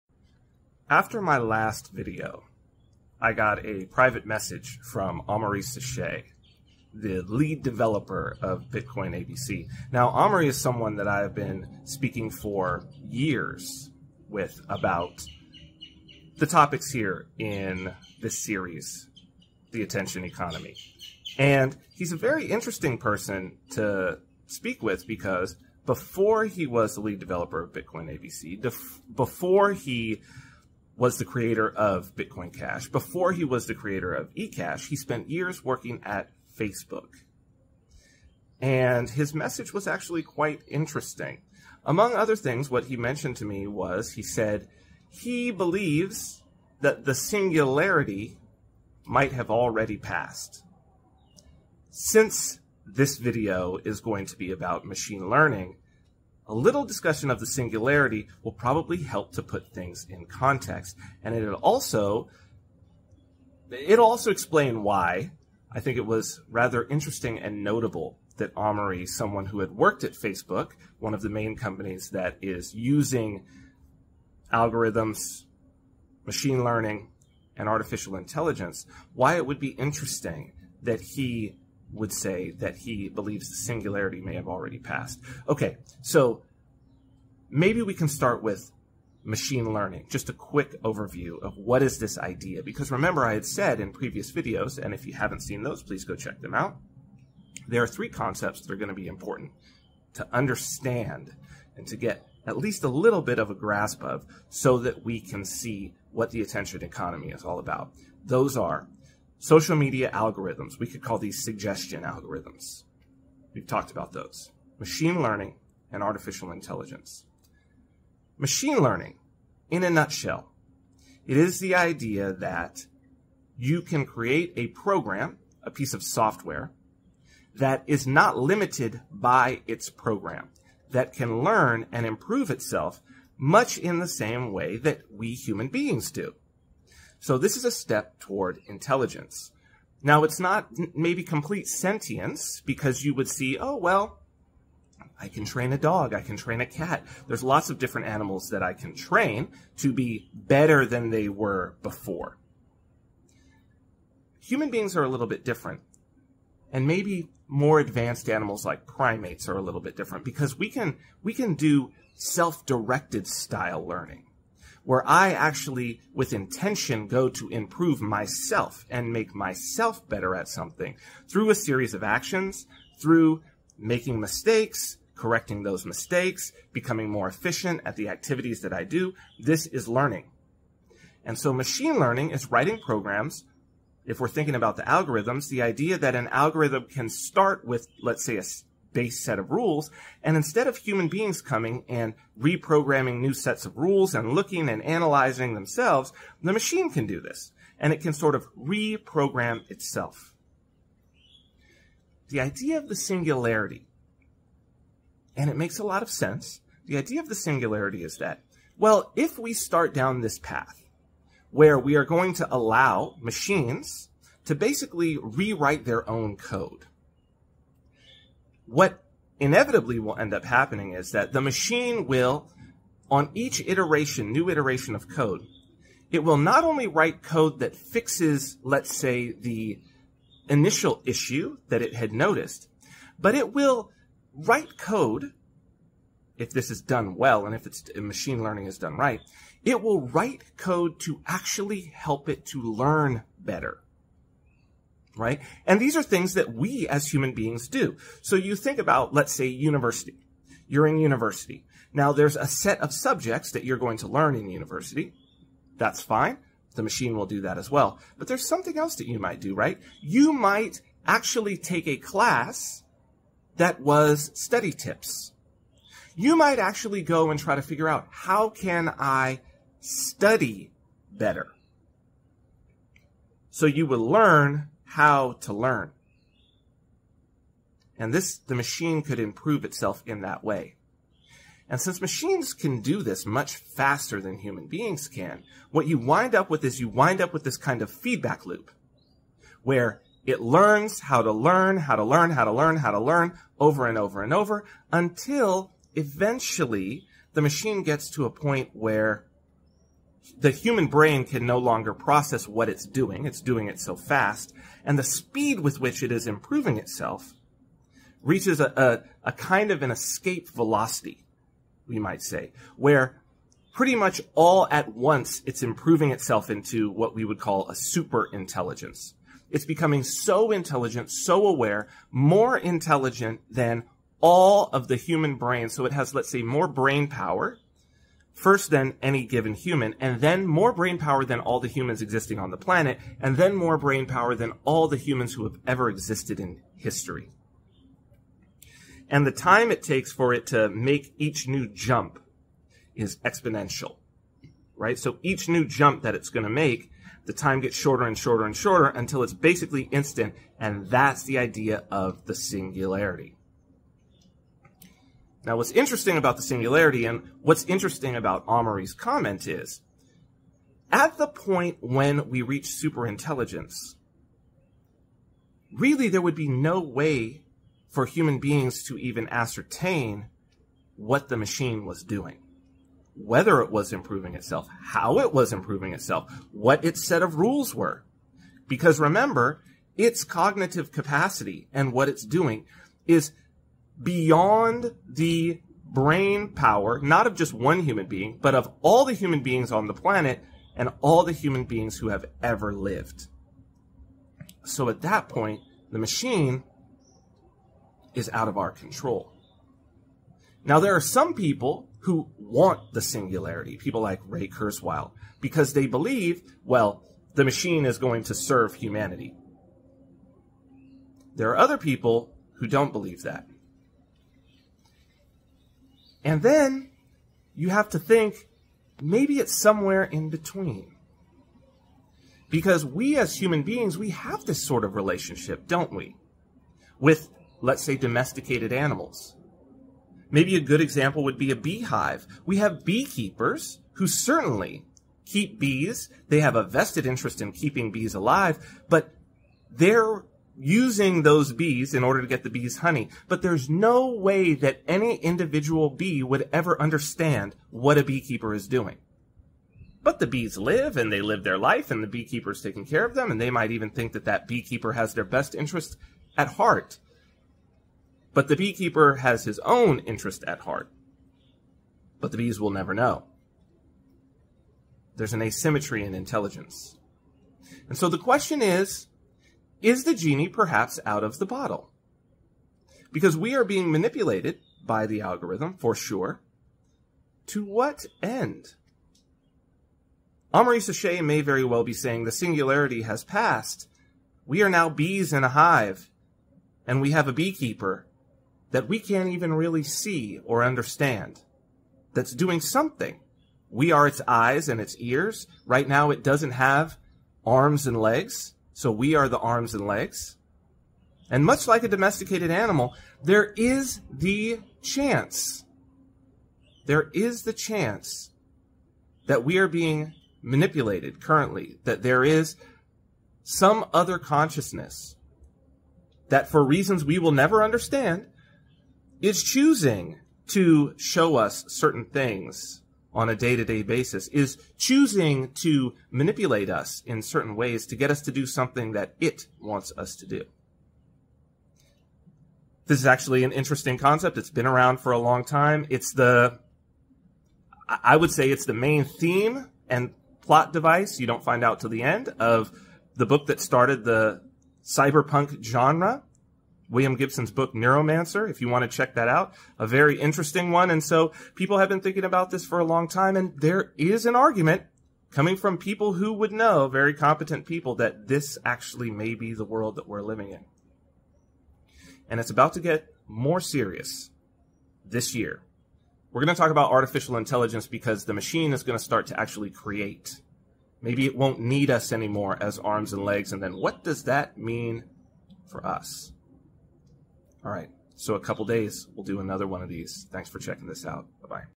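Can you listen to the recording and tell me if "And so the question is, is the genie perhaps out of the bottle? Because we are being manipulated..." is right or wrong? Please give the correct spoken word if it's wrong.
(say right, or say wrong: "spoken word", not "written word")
right.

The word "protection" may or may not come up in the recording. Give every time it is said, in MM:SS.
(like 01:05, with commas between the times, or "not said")
not said.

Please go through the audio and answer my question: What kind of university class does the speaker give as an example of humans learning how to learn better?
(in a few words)
study tips.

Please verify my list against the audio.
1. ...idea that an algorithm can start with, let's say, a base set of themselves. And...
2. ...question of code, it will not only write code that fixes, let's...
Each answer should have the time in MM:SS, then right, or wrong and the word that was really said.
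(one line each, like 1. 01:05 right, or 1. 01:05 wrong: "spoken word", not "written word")
1. 03:05 wrong: "rules", not "themselves"
2. 03:44 wrong: "iteration", not "question".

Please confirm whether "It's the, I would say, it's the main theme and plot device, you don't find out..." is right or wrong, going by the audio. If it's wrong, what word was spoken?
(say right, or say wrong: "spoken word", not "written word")
right.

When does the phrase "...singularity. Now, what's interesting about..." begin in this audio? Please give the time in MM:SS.
05:52.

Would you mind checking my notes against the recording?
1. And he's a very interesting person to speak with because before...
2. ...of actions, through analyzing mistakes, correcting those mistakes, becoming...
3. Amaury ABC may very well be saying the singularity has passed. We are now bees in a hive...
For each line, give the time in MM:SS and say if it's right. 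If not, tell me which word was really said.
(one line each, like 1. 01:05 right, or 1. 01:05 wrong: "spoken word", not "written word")
1. 00:21 right
2. 02:51 wrong: "making", not "analyzing"
3. 08:00 wrong: "Sachet", not "ABC".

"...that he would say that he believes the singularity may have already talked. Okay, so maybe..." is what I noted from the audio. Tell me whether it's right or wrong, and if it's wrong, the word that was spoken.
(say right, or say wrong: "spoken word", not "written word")
wrong: "passed", not "talked".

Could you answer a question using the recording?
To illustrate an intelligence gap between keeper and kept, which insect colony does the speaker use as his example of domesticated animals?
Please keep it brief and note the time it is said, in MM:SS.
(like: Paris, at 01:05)
a beehive, at 07:11.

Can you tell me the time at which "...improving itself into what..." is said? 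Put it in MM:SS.
05:15.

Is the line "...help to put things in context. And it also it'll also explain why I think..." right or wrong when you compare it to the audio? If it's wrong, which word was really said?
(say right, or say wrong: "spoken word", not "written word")
right.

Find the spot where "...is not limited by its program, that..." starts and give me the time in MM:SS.
02:07.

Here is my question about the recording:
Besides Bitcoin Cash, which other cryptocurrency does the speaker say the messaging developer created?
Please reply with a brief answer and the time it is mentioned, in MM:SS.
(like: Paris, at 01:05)
eCash, at 00:34.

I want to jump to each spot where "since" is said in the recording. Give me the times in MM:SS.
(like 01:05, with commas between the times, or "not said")
00:51, 04:41.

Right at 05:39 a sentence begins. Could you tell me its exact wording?
And the time it takes for it to make each new jump is exponential, right?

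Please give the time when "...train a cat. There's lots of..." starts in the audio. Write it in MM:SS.
02:26.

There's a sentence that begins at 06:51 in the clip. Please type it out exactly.
There are other people who don't believe that.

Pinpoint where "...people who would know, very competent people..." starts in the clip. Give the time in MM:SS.
09:15.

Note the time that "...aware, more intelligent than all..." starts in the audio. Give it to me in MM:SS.
05:21.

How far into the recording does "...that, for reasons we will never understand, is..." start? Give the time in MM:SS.
08:36.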